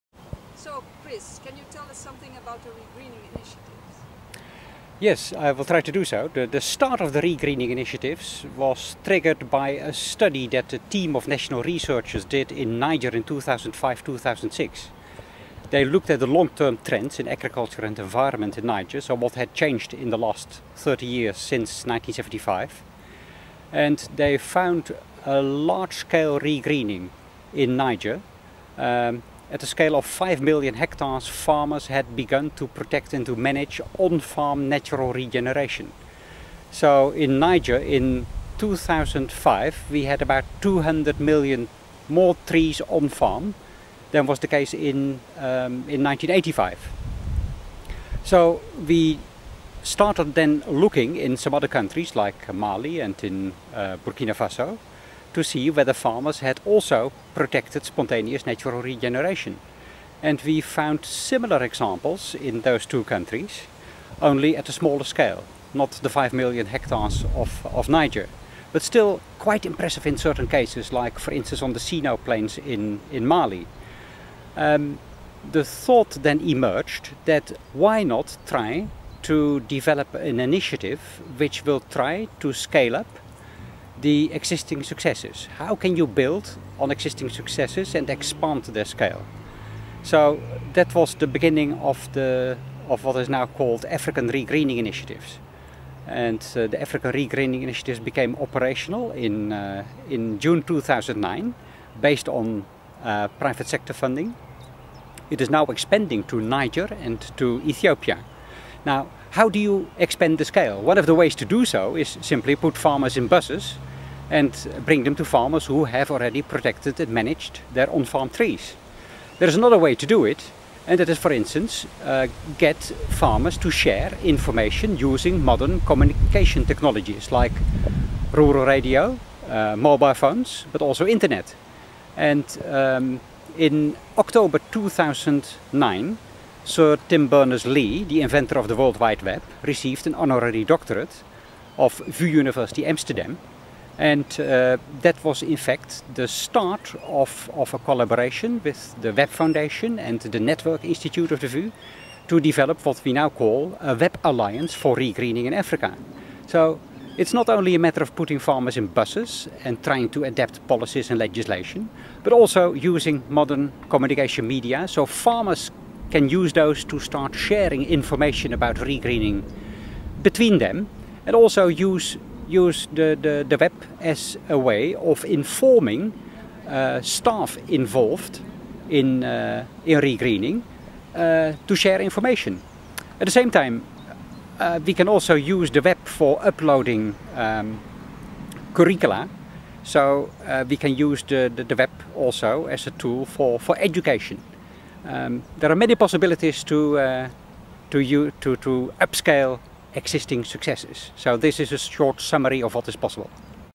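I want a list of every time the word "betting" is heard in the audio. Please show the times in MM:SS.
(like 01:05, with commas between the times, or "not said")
not said.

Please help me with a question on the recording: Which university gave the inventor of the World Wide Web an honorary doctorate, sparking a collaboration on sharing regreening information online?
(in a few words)
VU University Amsterdam.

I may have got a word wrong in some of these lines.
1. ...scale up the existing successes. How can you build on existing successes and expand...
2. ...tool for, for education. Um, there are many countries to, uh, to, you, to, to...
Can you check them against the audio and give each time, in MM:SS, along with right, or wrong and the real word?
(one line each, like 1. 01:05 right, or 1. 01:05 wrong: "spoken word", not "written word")
1. 01:22 right
2. 03:12 wrong: "possibilities", not "countries".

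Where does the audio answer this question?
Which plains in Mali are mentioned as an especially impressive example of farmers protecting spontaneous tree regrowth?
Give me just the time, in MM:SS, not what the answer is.
01:11.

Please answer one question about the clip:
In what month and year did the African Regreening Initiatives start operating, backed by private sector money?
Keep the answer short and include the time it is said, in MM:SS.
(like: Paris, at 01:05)
June 2009, at 01:40.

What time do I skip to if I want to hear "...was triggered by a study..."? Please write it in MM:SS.
00:08.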